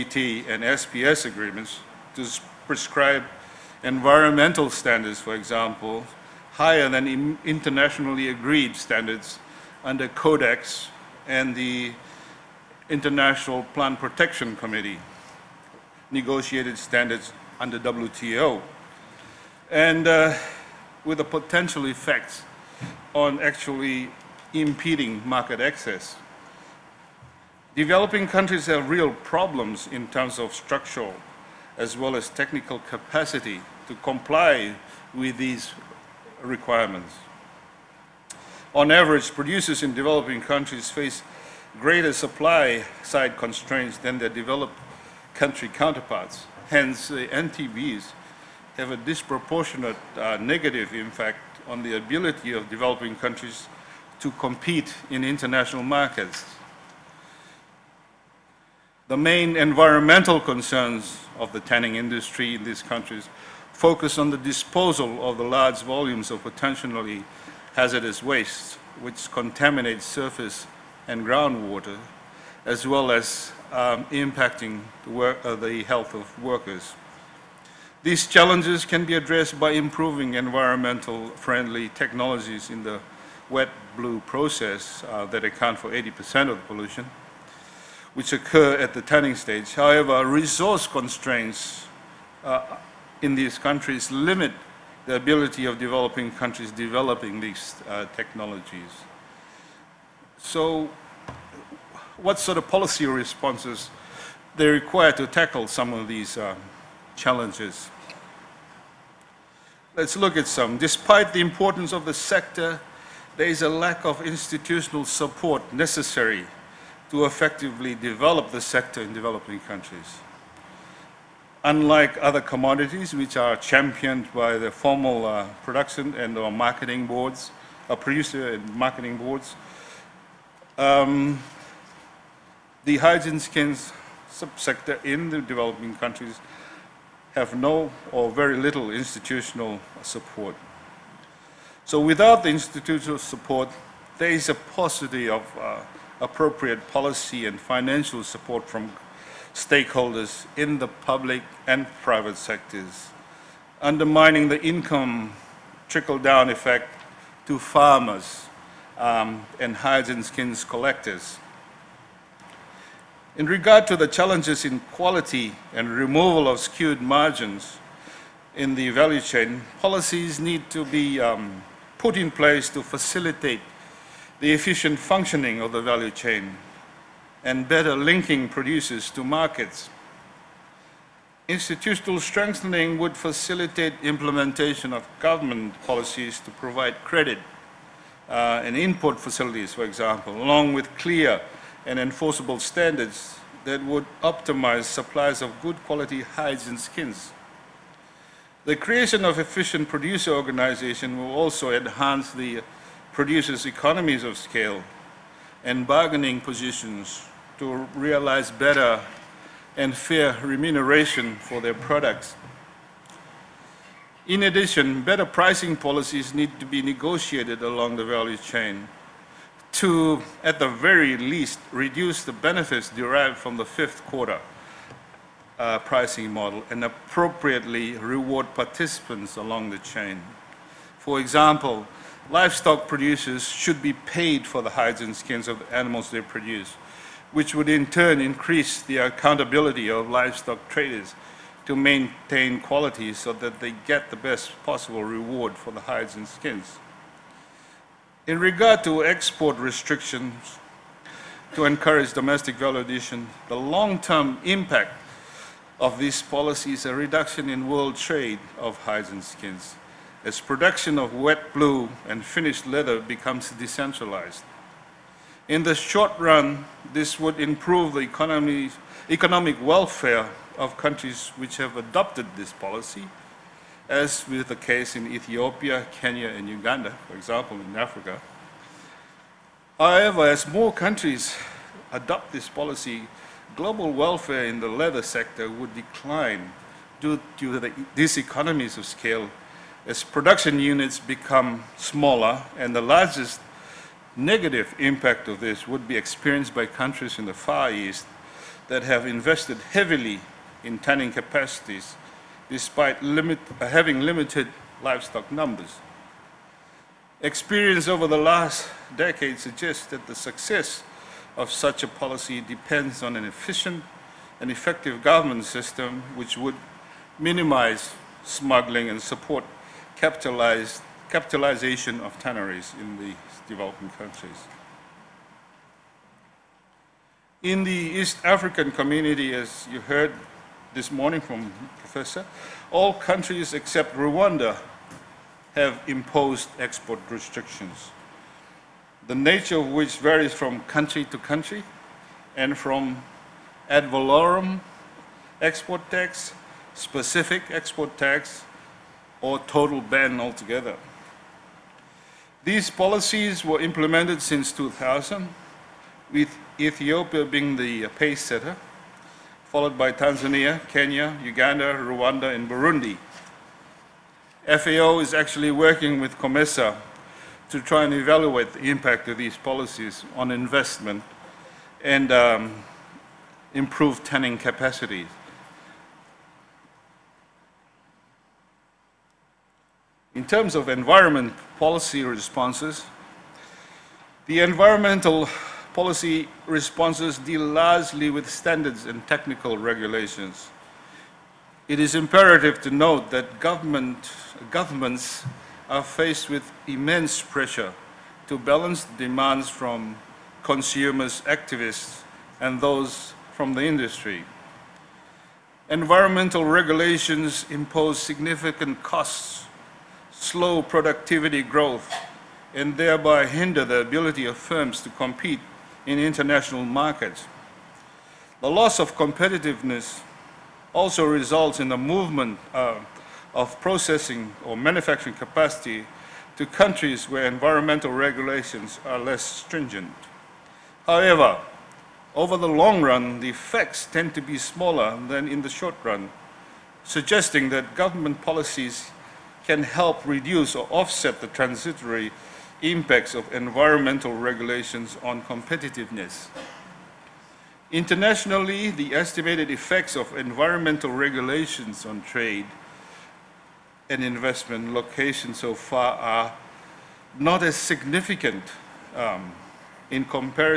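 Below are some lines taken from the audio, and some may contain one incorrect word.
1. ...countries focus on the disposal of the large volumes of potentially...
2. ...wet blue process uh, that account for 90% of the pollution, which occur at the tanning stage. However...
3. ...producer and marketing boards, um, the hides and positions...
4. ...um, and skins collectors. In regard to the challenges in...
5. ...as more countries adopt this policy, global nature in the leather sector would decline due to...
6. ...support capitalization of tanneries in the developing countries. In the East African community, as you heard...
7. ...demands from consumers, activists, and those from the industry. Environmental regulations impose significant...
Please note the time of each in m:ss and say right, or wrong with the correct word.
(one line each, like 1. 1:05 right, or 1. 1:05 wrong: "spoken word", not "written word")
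1. 1:02 right
2. 1:23 wrong: "80", not "90"
3. 2:07 wrong: "skins", not "positions"
4. 2:38 right
5. 4:40 wrong: "welfare", not "nature"
6. 5:18 right
7. 6:38 right.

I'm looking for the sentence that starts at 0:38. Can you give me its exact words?
On average, producers in developing countries face greater supply side constraints than their developed country counterparts.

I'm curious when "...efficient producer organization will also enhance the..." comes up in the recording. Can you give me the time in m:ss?
3:19.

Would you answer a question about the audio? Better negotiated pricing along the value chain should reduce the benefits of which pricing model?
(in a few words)
fifth quarter.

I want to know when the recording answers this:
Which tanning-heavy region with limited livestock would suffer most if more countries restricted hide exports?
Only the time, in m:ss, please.
4:57.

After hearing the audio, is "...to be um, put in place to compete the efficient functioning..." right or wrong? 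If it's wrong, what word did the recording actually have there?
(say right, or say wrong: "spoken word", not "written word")
wrong: "facilitate", not "compete".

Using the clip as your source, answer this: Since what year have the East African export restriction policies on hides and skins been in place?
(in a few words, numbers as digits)
2000.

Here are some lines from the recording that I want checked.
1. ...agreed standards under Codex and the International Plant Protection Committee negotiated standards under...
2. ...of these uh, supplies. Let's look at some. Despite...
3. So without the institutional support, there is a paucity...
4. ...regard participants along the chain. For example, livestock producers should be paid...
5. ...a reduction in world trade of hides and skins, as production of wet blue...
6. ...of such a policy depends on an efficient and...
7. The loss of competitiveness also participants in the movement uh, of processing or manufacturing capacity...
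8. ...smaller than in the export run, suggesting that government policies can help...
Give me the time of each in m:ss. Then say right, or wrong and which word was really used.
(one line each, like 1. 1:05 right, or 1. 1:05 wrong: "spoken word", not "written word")
1. 0:08 right
2. 1:45 wrong: "challenges", not "supplies"
3. 2:21 right
4. 3:47 wrong: "reward", not "regard"
5. 4:16 right
6. 5:11 right
7. 6:58 wrong: "results", not "participants"
8. 7:14 wrong: "short", not "export".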